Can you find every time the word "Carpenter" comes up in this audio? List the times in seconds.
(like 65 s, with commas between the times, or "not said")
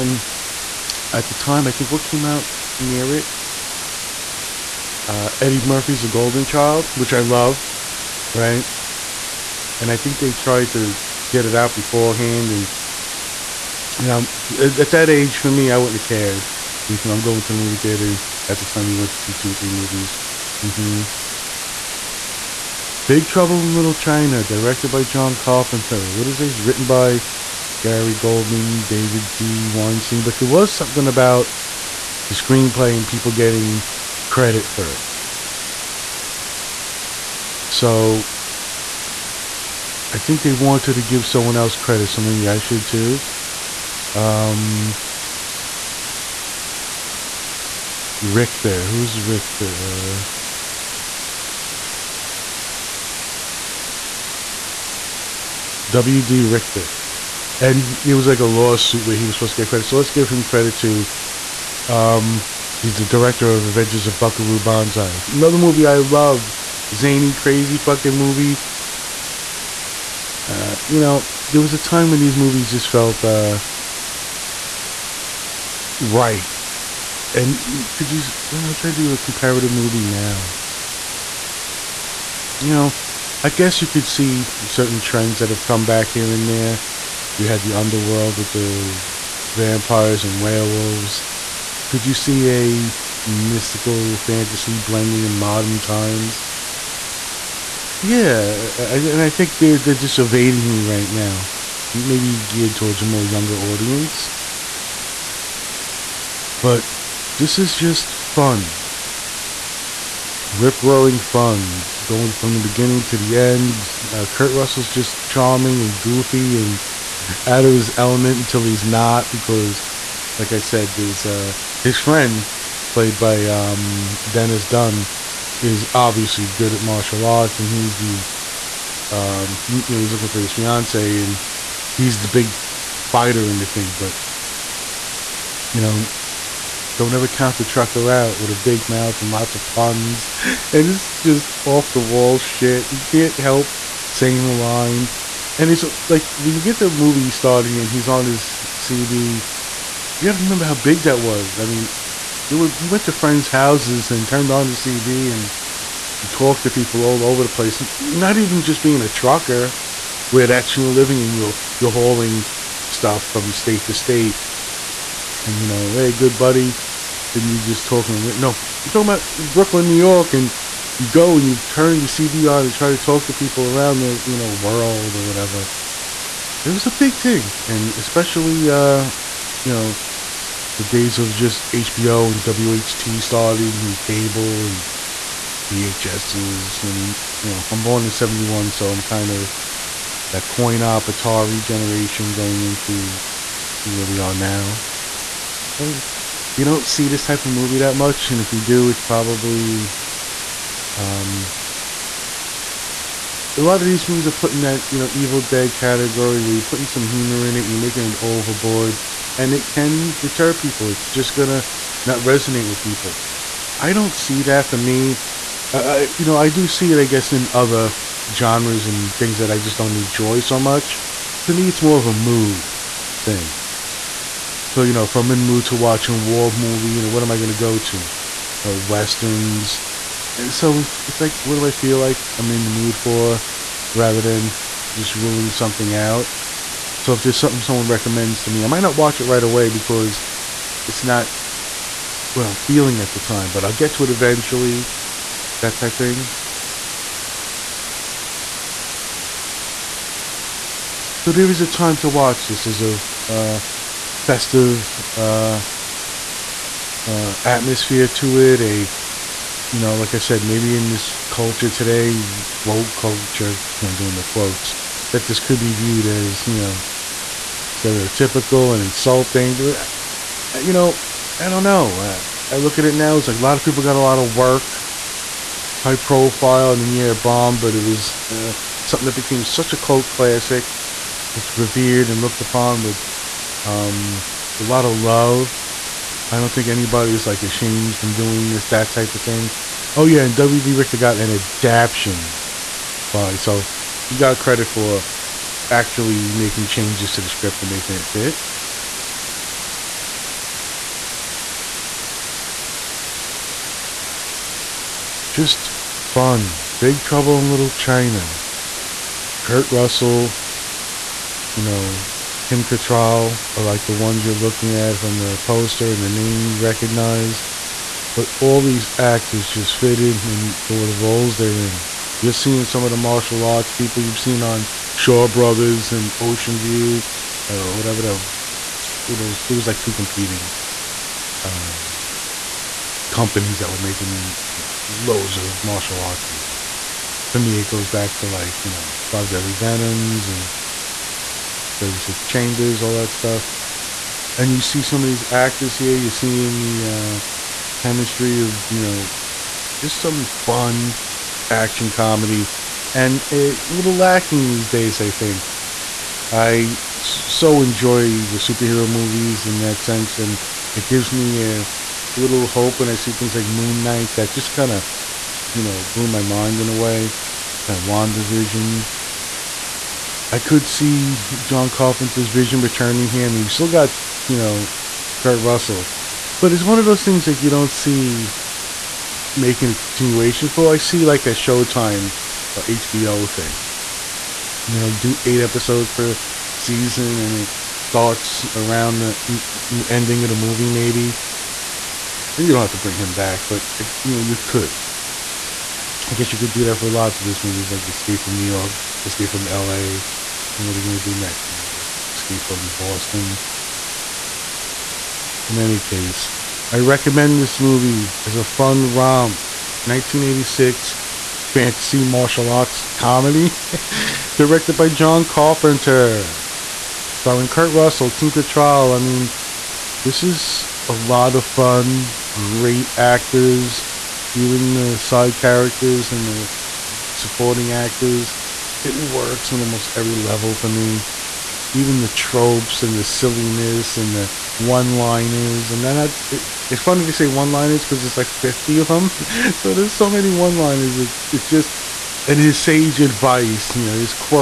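25 s, 371 s, 415 s.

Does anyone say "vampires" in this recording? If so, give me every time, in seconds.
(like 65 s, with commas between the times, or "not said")
89 s.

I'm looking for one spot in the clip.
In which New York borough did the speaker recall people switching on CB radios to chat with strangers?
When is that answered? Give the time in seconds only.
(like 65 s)
169 s.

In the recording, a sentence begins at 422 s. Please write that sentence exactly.
Great actors, even the side characters and the supporting actors it works on almost every level for me.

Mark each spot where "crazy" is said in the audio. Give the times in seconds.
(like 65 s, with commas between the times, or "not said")
67 s.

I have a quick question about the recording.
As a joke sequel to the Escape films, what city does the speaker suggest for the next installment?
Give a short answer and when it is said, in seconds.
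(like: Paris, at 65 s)
Boston, at 402 s.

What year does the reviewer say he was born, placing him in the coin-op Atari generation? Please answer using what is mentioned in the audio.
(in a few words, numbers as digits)
1971.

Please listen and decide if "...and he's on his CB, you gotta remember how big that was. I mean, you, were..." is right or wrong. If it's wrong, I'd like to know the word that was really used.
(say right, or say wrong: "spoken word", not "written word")
right.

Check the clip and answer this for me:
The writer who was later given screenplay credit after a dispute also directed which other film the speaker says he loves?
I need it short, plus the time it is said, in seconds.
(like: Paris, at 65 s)
Adventures of Buckaroo Banzai, at 63 s.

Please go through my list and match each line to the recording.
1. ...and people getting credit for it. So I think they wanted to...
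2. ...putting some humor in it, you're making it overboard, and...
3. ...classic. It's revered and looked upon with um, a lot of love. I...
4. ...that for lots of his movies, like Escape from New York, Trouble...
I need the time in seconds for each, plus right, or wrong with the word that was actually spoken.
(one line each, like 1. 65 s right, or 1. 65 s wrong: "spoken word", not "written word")
1. 32 s right
2. 206 s right
3. 280 s right
4. 396 s wrong: "Escape", not "Trouble".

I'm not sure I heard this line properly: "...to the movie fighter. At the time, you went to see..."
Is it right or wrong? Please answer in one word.
wrong.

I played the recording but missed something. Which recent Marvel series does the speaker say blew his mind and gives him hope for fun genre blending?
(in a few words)
Moon Knight.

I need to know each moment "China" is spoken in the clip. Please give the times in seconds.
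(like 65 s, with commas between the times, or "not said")
23 s, 307 s.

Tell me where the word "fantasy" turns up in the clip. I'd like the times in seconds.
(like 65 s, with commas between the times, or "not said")
94 s, 411 s.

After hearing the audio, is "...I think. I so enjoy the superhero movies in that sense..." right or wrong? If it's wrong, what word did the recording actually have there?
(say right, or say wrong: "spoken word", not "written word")
right.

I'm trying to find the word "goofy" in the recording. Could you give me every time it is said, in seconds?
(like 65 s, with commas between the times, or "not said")
115 s.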